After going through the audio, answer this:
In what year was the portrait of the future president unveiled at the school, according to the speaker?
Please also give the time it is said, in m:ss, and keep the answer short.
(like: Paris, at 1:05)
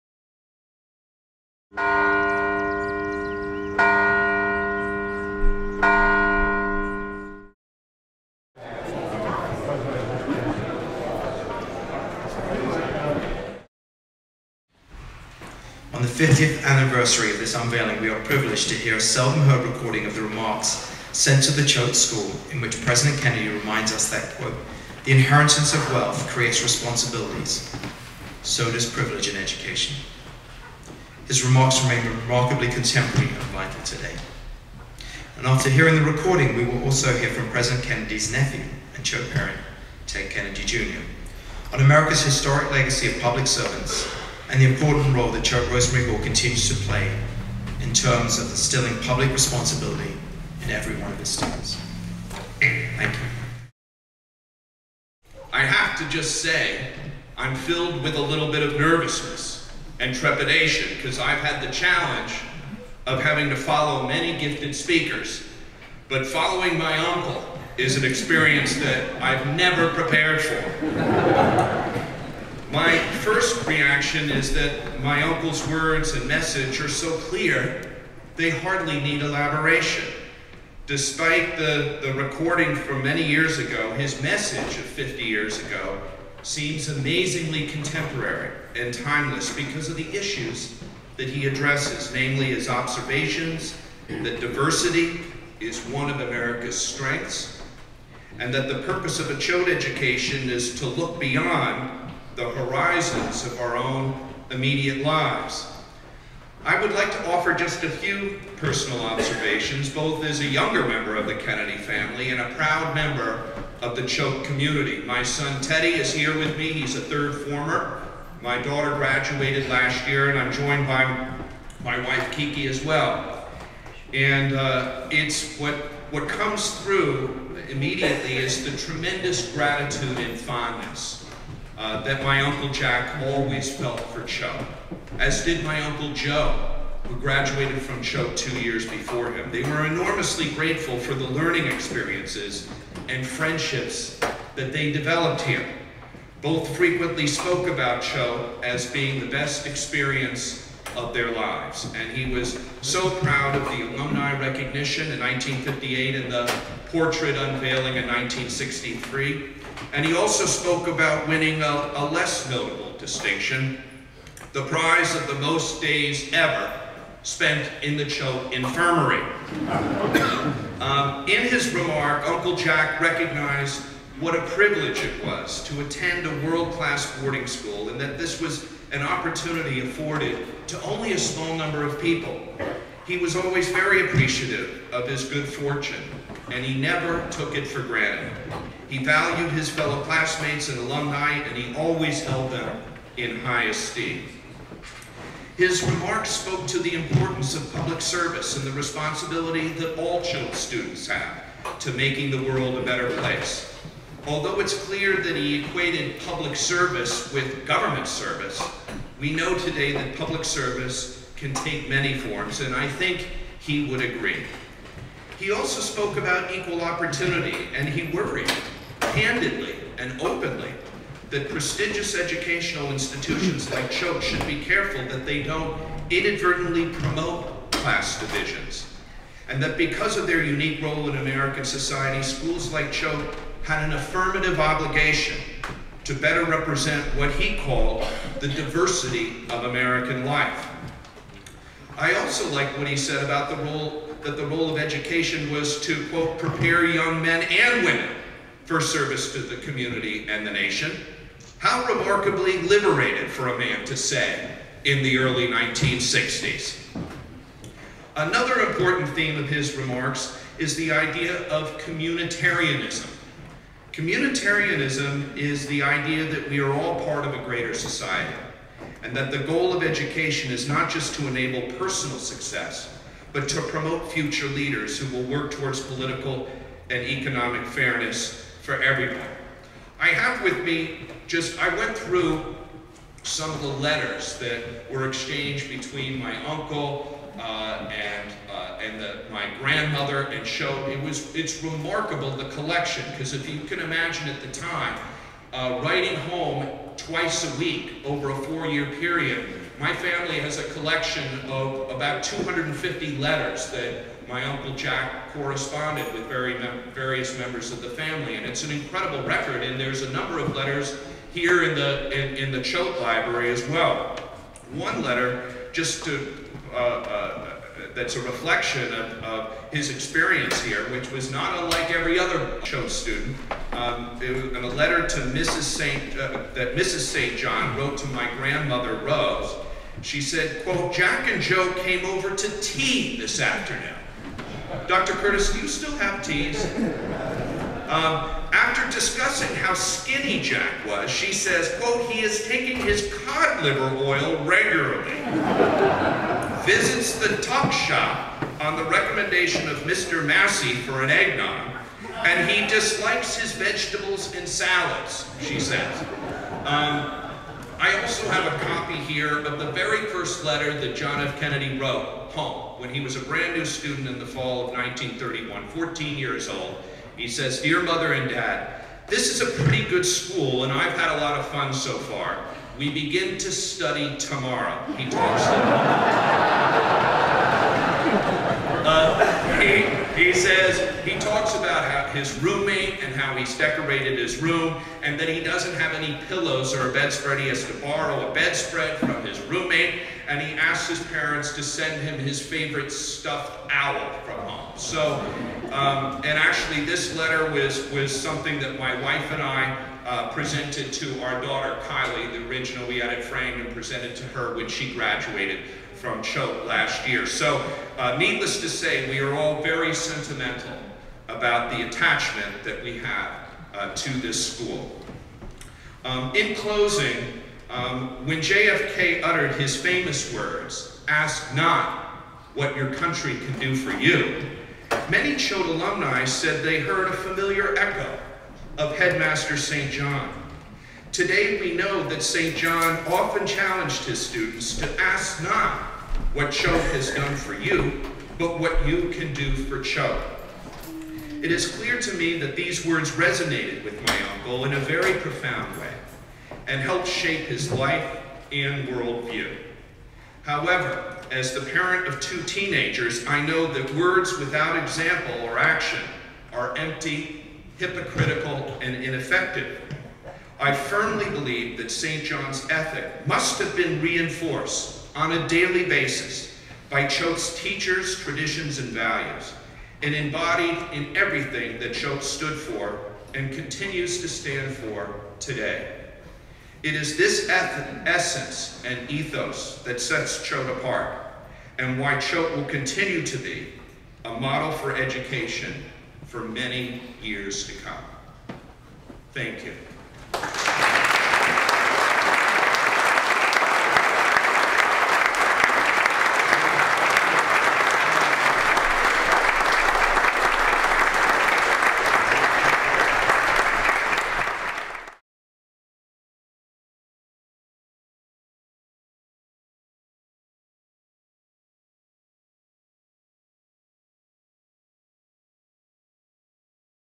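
1963, at 2:38.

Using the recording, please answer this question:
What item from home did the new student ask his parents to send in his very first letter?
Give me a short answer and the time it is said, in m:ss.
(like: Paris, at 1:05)
Stuffed owl, at 6:32.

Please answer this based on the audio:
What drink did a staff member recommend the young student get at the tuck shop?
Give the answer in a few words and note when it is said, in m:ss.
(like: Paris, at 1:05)
Eggnog, at 5:51.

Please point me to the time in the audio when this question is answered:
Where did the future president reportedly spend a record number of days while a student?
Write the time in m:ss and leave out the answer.
2:48.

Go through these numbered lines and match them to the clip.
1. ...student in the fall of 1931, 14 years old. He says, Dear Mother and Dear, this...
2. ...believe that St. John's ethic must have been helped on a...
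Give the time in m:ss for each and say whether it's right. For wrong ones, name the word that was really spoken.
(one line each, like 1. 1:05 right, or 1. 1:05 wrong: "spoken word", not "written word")
1. 6:03 wrong: "Dad", not "Dear"
2. 7:41 wrong: "reinforced", not "helped".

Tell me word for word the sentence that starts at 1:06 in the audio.
But following my uncle is an experience that I've never prepared for.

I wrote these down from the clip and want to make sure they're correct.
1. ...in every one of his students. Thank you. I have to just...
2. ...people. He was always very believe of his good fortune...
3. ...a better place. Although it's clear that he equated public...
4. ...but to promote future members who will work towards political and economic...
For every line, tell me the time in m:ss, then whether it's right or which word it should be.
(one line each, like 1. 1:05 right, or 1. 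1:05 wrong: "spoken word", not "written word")
1. 0:50 right
2. 3:02 wrong: "appreciative", not "believe"
3. 3:22 right
4. 4:33 wrong: "leaders", not "members".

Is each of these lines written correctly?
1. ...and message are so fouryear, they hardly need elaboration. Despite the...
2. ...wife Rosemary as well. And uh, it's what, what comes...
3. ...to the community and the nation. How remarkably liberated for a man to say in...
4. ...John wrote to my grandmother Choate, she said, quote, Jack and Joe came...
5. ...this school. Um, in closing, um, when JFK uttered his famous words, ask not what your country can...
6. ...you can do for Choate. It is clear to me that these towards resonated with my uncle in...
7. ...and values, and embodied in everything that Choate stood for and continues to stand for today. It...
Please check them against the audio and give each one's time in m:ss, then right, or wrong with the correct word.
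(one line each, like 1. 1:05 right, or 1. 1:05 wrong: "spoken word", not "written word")
1. 1:16 wrong: "clear", not "fouryear"
2. 2:02 wrong: "Kiki", not "Rosemary"
3. 4:09 right
4. 5:27 wrong: "Rose", not "Choate"
5. 6:54 right
6. 7:18 wrong: "words", not "towards"
7. 7:48 right.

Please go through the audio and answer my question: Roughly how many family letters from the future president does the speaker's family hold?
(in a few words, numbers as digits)
250.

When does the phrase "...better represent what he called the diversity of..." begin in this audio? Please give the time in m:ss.
3:56.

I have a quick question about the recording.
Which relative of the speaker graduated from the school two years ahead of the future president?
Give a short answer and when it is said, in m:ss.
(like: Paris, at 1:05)
Uncle Joe, at 2:15.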